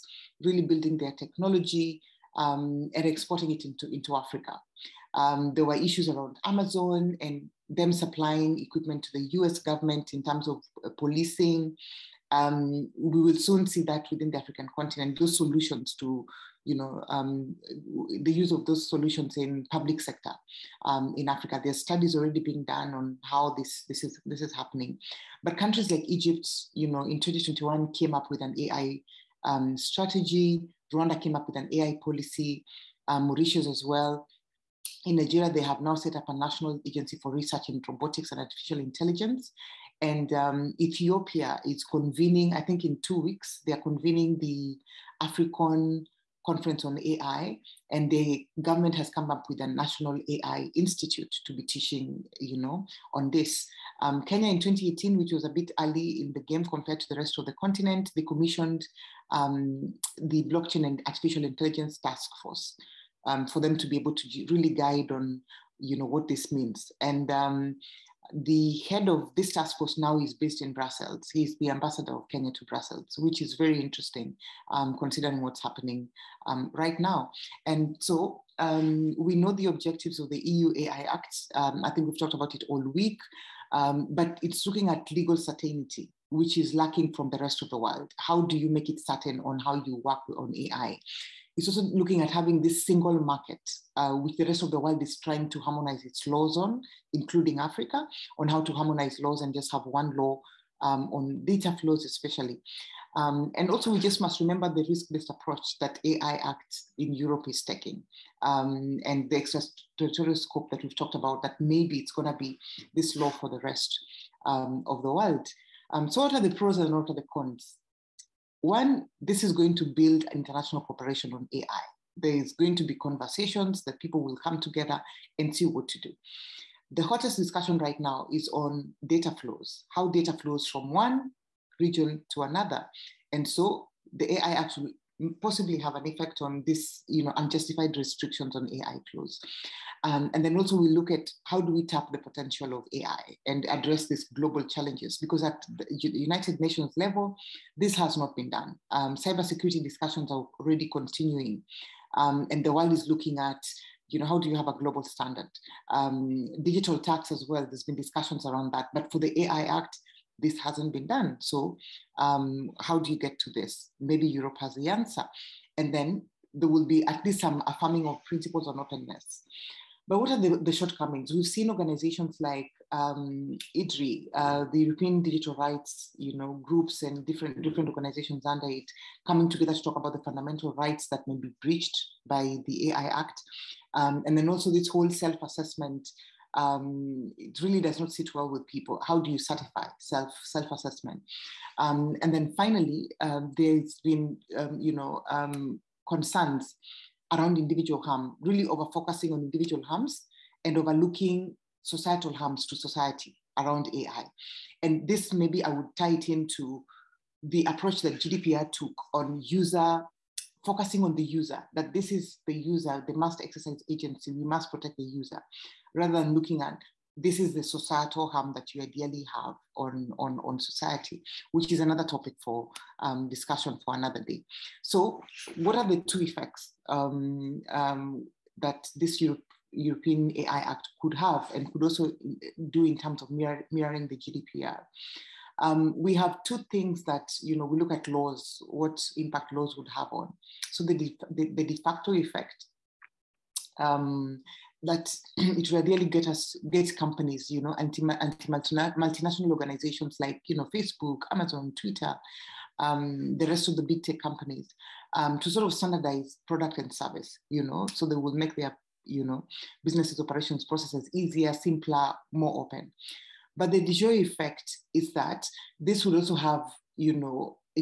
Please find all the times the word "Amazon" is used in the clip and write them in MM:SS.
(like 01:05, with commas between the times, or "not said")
00:06, 04:11.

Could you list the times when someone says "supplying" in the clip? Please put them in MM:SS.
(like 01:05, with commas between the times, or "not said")
00:07.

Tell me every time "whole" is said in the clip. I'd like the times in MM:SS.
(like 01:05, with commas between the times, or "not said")
03:04.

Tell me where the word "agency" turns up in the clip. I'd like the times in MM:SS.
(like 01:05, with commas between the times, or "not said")
00:36, 03:33.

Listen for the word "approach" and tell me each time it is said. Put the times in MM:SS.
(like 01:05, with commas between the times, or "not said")
01:45, 03:27.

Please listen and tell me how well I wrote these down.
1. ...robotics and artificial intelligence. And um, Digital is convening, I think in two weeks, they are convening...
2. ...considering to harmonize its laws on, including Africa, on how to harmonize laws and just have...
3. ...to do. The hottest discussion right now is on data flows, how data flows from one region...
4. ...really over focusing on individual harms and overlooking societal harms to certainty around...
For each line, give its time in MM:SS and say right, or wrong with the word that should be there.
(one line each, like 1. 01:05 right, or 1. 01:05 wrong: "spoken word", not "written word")
1. 00:37 wrong: "Ethiopia", not "Digital"
2. 01:35 wrong: "trying", not "considering"
3. 02:05 right
4. 03:18 wrong: "society", not "certainty".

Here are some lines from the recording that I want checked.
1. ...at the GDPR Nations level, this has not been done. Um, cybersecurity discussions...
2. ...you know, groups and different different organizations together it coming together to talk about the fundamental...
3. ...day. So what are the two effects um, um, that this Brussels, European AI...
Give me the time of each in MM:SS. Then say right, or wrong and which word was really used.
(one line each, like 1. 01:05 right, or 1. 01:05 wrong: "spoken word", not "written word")
1. 02:25 wrong: "United", not "GDPR"
2. 02:56 wrong: "under", not "together"
3. 03:44 wrong: "Europe", not "Brussels".